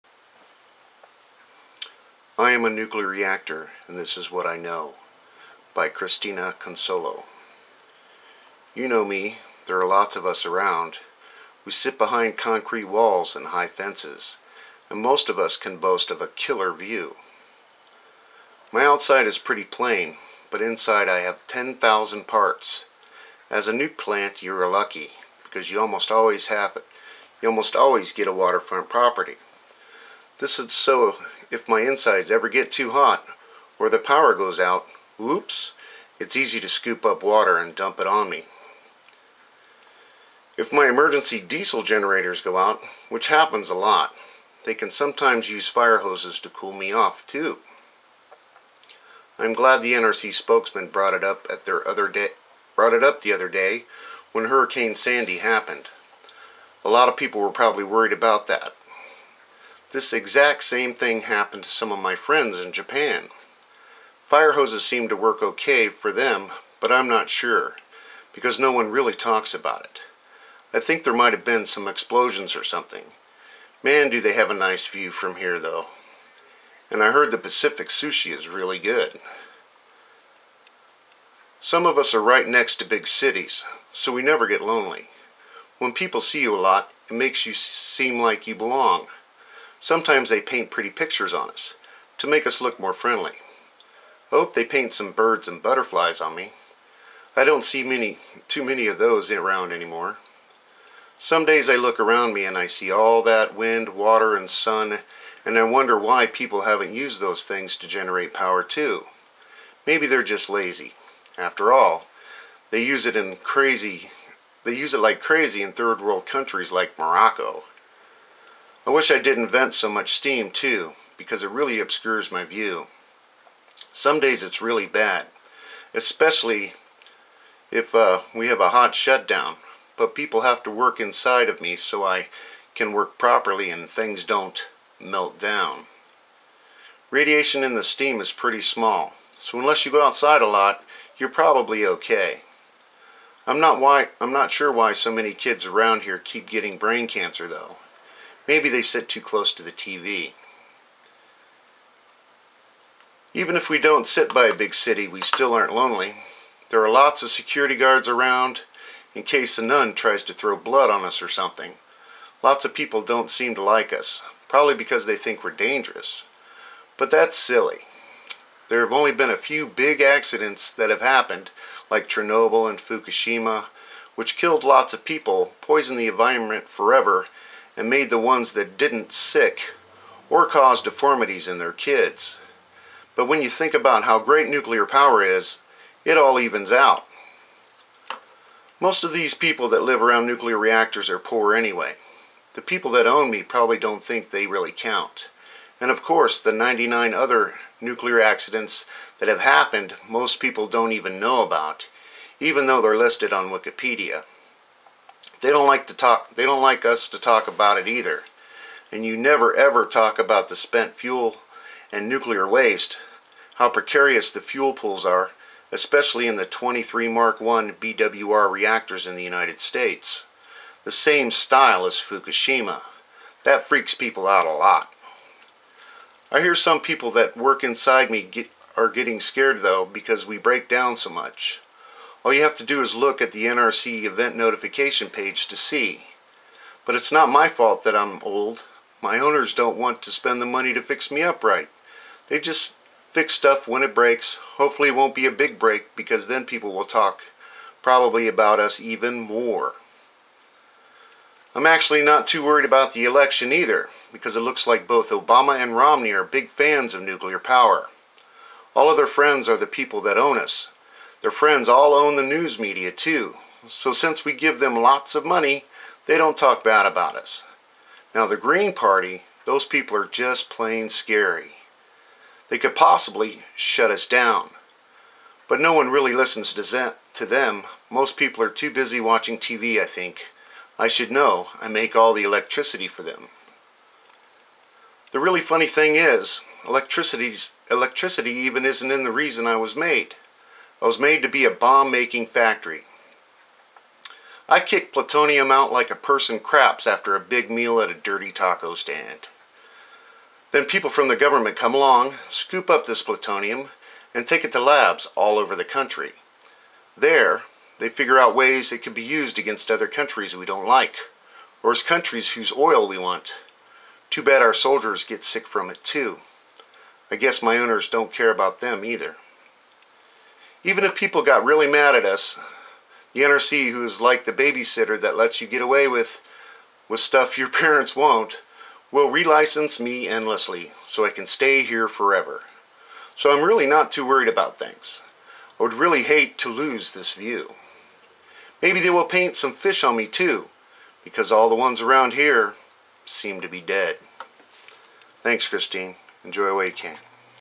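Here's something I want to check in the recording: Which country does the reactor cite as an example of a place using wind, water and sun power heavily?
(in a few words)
Morocco.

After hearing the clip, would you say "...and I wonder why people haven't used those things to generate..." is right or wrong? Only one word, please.
right.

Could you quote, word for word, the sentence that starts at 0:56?
A lot of people were probably worried about that, this exact same thing happened to some of my friends in Japan.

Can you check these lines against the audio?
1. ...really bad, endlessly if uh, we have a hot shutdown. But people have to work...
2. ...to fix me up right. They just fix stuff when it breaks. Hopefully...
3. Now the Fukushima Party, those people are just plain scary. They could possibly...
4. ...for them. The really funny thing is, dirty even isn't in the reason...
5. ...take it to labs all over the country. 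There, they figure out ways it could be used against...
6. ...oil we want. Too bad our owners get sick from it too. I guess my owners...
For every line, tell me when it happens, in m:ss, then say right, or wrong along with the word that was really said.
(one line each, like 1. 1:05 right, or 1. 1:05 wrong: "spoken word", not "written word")
1. 2:04 wrong: "especially", not "endlessly"
2. 4:00 right
3. 4:28 wrong: "Green", not "Fukushima"
4. 4:42 wrong: "electricity", not "dirty"
5. 5:04 right
6. 5:12 wrong: "soldiers", not "owners".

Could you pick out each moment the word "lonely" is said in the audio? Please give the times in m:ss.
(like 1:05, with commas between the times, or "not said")
1:24, 2:35.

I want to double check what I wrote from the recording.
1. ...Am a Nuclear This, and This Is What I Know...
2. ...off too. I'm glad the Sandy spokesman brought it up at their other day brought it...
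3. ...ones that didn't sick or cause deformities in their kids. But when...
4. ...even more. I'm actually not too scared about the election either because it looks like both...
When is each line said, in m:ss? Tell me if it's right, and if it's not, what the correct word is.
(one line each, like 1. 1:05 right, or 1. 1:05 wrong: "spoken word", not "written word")
1. 0:02 wrong: "Reactor", not "This"
2. 0:46 wrong: "NRC", not "Sandy"
3. 2:58 right
4. 4:08 wrong: "worried", not "scared".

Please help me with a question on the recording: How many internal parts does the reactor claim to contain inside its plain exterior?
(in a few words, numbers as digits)
10,000.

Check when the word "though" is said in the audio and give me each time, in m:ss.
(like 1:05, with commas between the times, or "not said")
1:15, 2:27, 3:22, 3:49.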